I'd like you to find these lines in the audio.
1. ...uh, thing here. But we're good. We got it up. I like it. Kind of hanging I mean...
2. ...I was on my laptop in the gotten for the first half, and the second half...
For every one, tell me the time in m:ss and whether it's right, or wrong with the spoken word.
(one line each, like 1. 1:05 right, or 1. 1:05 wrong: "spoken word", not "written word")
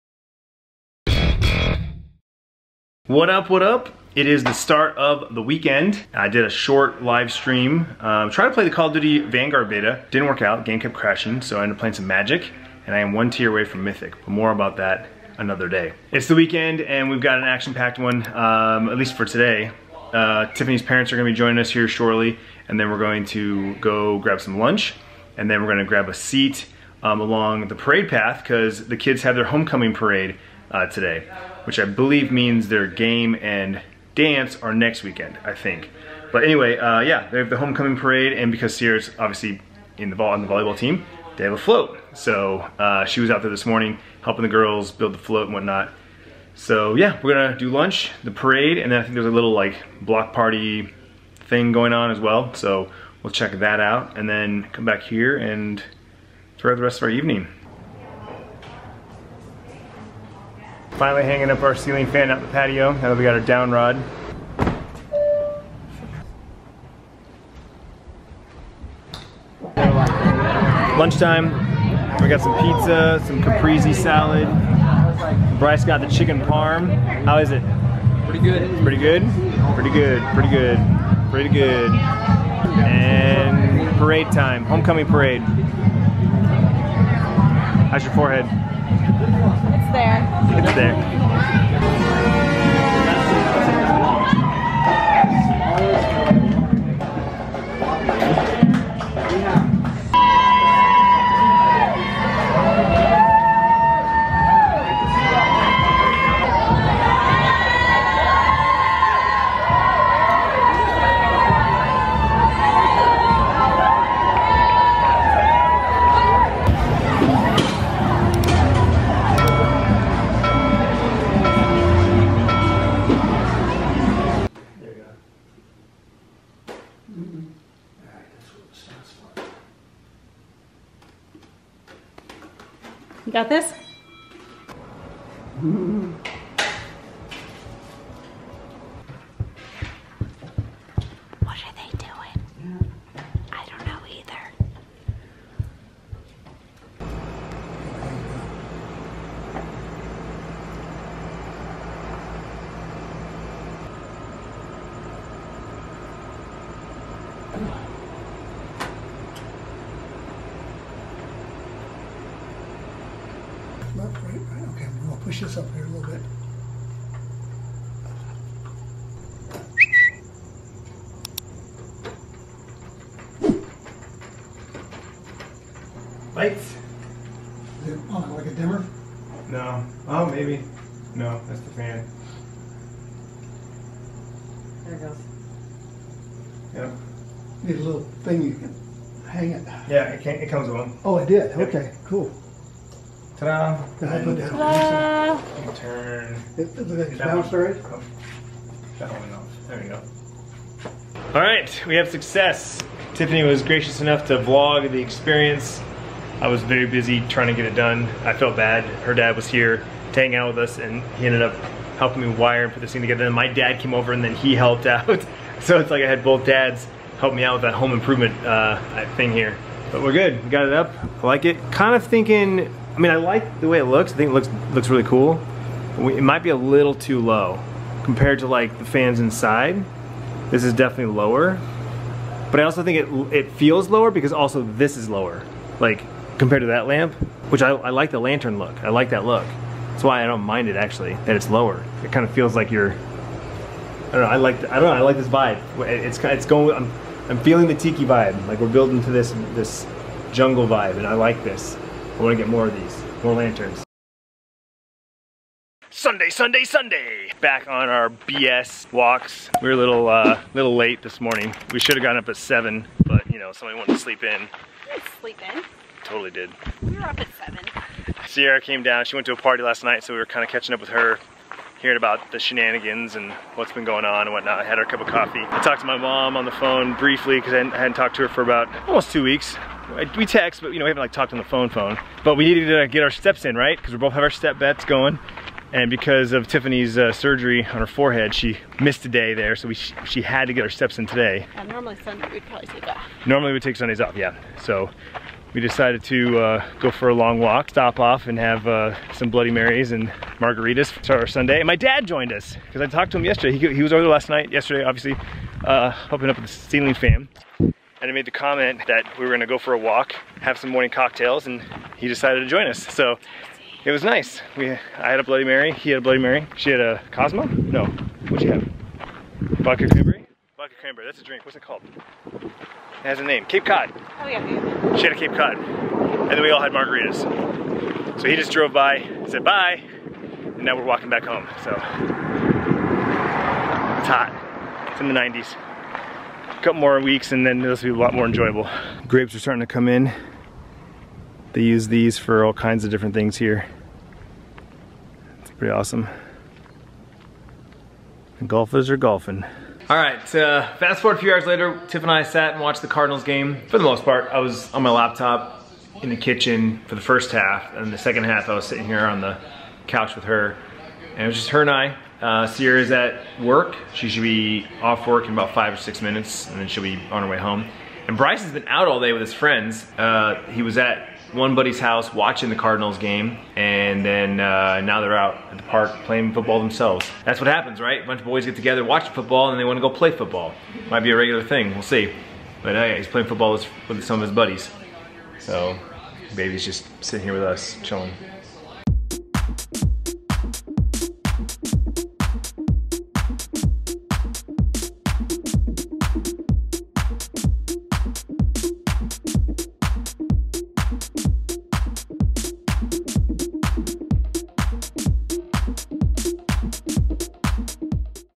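1. 3:38 wrong: "thinking", not "hanging"
2. 5:54 wrong: "kitchen", not "gotten".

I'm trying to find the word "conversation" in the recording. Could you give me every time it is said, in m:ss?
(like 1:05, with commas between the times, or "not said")
not said.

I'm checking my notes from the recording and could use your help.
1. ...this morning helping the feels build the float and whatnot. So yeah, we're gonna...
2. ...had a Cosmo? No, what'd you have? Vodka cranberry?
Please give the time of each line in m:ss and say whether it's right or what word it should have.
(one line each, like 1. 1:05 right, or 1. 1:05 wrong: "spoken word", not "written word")
1. 0:43 wrong: "girls", not "feels"
2. 5:16 right.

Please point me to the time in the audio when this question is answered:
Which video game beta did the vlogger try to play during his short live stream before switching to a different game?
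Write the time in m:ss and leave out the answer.
0:08.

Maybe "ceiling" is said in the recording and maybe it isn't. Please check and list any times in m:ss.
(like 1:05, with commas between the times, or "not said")
1:01, 5:06.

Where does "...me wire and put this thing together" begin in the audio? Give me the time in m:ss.
3:32.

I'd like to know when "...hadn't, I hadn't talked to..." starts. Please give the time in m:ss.
4:37.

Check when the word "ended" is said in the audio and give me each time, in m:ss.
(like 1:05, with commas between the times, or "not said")
0:11, 3:31.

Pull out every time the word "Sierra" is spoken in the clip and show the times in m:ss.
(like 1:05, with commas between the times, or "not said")
0:38, 4:28, 6:02.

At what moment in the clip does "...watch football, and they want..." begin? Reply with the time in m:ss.
6:18.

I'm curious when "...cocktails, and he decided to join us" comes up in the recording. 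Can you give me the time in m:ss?
5:10.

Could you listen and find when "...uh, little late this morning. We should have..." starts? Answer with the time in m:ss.
4:20.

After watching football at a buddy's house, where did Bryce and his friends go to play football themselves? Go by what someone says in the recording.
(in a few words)
the park.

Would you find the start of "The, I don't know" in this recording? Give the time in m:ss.
4:04.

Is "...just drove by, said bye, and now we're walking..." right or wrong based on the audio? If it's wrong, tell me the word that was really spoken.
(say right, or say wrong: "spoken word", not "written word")
right.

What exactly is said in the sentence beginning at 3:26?
I was very busy trying to get it done.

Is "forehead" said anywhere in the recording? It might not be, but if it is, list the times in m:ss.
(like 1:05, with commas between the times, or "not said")
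1:28, 4:47.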